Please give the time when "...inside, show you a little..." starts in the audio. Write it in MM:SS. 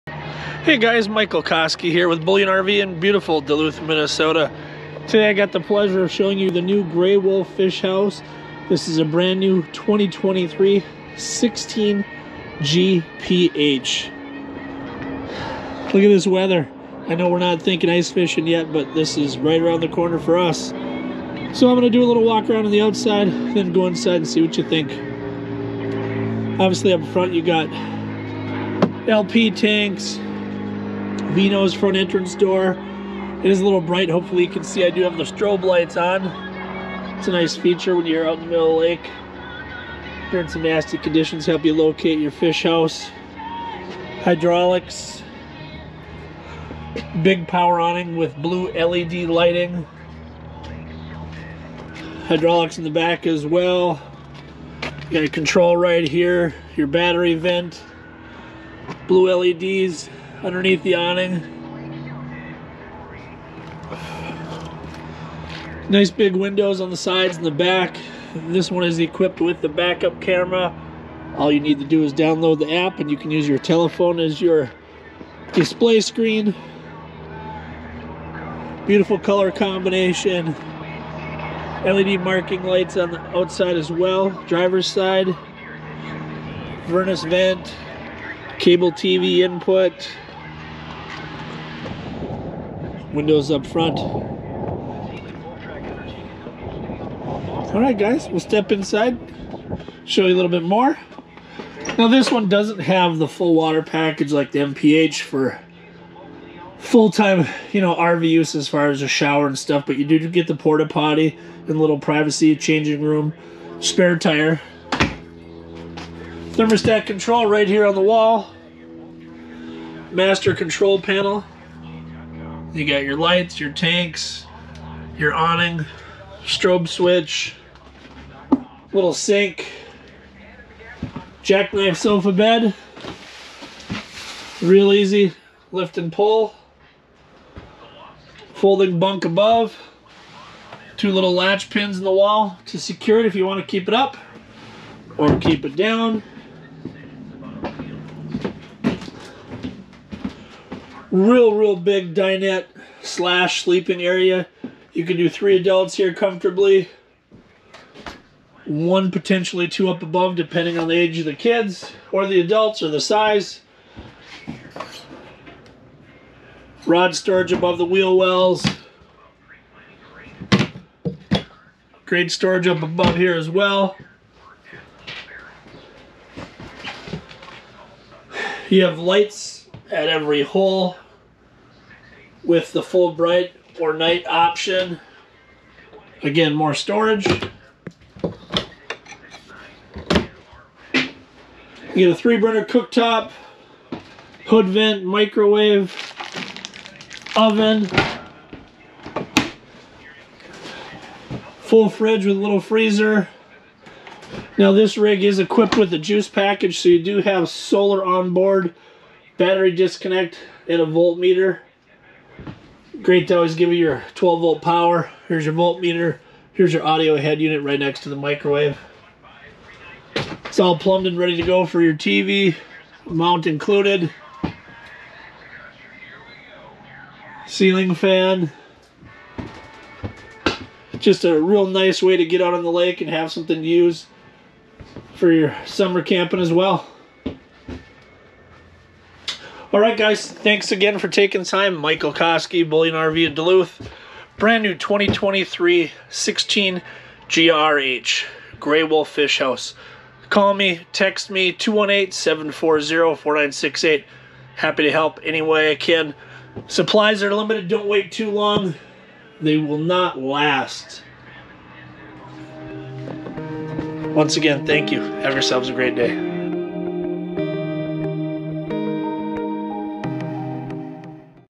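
01:38.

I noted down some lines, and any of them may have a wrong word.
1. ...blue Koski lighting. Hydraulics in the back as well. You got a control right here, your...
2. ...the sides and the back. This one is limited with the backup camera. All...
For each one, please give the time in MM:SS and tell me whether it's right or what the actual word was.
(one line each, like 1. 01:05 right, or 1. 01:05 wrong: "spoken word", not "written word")
1. 00:48 wrong: "LED", not "Koski"
2. 01:06 wrong: "equipped", not "limited".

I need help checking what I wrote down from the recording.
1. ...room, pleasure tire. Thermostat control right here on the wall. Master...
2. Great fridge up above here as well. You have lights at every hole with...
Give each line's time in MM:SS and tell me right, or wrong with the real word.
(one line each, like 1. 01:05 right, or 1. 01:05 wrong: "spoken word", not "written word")
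1. 01:53 wrong: "spare", not "pleasure"
2. 02:52 wrong: "storage", not "fridge".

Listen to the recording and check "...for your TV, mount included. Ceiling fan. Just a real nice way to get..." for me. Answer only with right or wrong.
right.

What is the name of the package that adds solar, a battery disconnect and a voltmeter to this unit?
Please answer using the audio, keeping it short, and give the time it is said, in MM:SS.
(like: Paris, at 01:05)
Juice package, at 03:25.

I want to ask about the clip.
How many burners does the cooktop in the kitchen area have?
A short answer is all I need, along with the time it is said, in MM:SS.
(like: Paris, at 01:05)
3, at 03:12.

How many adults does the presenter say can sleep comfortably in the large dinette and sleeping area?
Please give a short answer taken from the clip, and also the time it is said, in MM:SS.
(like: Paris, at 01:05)
3, at 02:35.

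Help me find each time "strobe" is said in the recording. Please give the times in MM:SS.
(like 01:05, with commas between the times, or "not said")
00:35, 02:06.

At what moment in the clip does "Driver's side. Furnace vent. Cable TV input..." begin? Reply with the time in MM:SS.
01:24.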